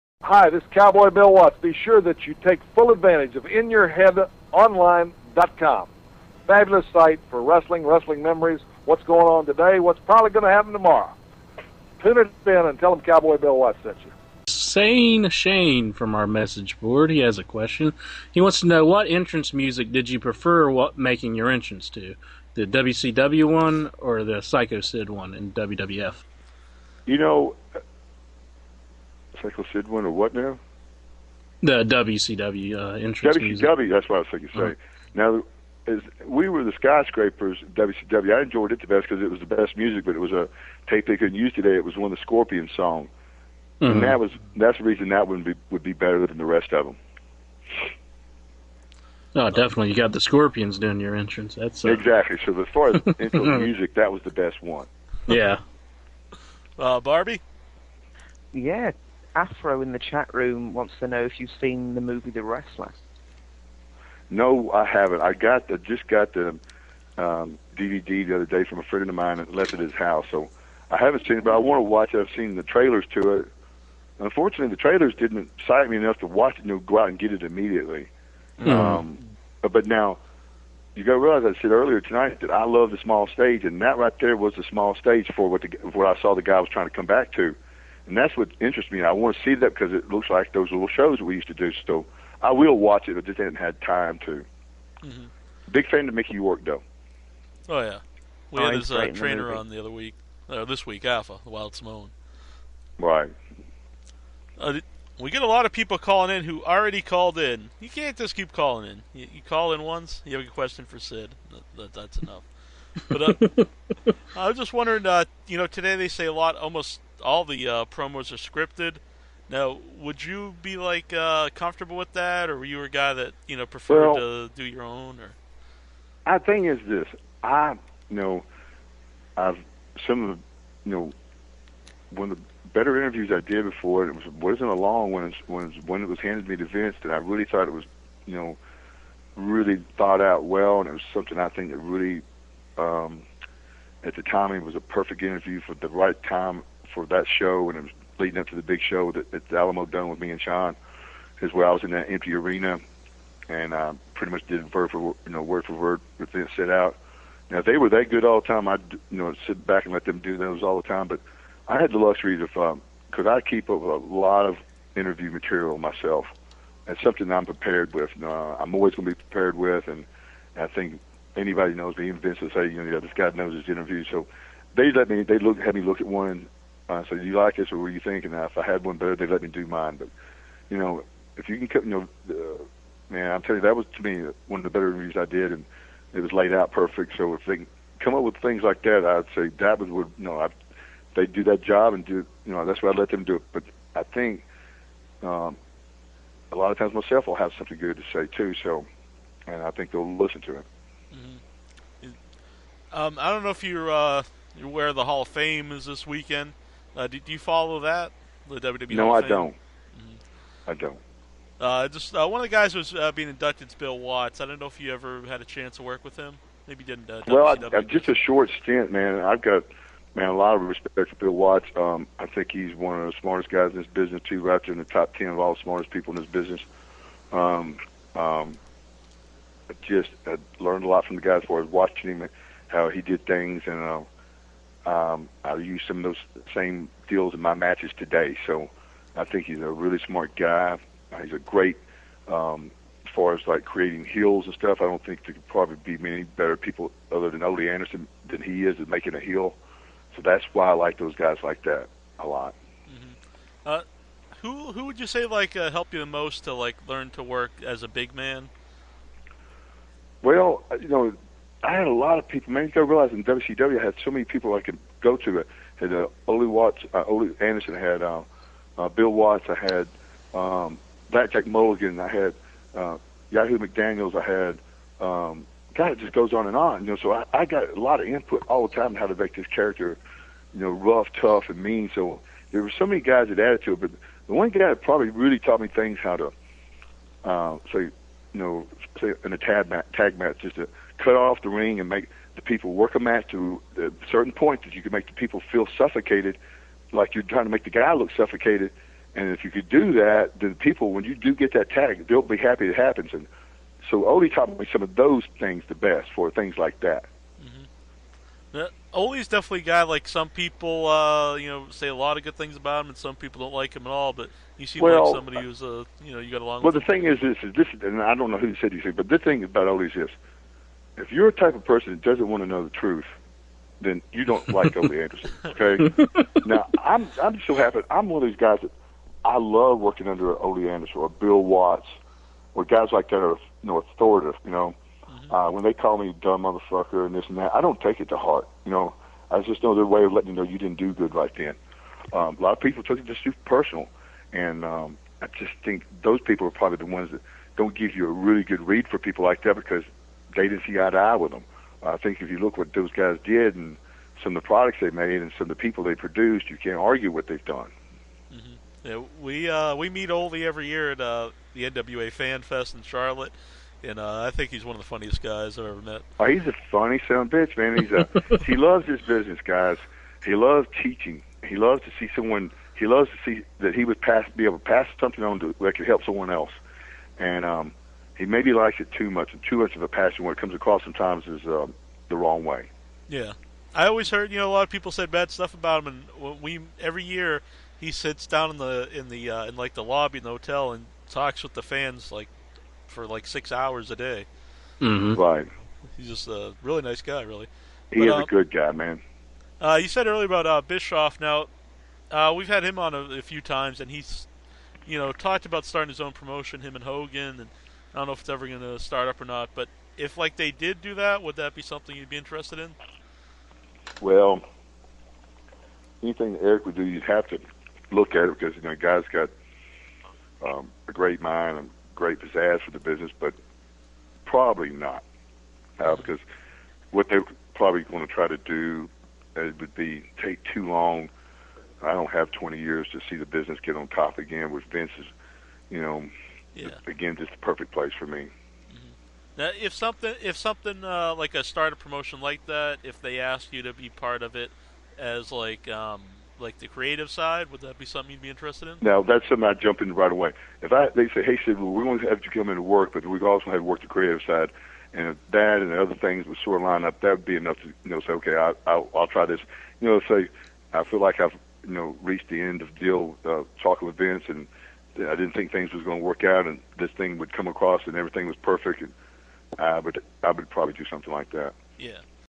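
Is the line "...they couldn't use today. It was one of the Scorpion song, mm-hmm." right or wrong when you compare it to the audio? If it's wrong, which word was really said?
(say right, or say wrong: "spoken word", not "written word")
right.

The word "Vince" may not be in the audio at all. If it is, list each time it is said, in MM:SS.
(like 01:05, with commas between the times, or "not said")
02:16, 02:52, 07:14, 07:43.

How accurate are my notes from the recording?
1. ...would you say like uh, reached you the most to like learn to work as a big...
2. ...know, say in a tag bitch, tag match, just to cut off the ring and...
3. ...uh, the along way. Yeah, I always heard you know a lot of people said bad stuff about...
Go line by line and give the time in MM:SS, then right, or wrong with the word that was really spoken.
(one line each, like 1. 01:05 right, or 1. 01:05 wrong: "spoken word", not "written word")
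1. 04:14 wrong: "helped", not "reached"
2. 04:48 wrong: "match", not "bitch"
3. 06:21 wrong: "wrong", not "along".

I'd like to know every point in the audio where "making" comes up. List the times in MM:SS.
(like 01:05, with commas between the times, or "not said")
00:20, 04:08.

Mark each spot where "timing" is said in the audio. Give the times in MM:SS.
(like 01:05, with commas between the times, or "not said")
not said.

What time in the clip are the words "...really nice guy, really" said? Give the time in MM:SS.
06:36.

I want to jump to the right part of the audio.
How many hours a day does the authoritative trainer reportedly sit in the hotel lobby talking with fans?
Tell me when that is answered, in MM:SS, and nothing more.
06:33.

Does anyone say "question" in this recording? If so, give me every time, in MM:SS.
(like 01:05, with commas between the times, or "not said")
00:17, 01:50.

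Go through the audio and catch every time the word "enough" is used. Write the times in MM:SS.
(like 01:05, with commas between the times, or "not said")
01:15, 01:52, 07:37.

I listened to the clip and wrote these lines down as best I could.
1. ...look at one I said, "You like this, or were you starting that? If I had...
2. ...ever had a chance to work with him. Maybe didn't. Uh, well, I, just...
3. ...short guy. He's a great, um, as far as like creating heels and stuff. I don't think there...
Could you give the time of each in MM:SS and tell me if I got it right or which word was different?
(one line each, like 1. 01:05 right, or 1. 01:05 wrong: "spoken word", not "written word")
1. 02:55 wrong: "thinking", not "starting"
2. 03:34 right
3. 03:59 wrong: "smart", not "short".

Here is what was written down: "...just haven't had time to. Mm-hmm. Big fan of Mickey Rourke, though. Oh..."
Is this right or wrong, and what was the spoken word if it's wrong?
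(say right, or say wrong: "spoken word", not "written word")
right.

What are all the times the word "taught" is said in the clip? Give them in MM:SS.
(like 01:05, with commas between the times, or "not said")
04:45, 05:04.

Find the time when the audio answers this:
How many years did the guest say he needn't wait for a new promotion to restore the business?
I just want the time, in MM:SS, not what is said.
07:12.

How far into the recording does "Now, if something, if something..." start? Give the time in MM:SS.
07:19.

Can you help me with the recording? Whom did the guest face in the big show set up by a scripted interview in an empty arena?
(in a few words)
Shawn.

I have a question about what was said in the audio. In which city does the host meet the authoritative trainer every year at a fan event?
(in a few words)
Charlotte.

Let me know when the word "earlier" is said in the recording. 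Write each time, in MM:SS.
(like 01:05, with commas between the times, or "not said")
01:21, 06:40.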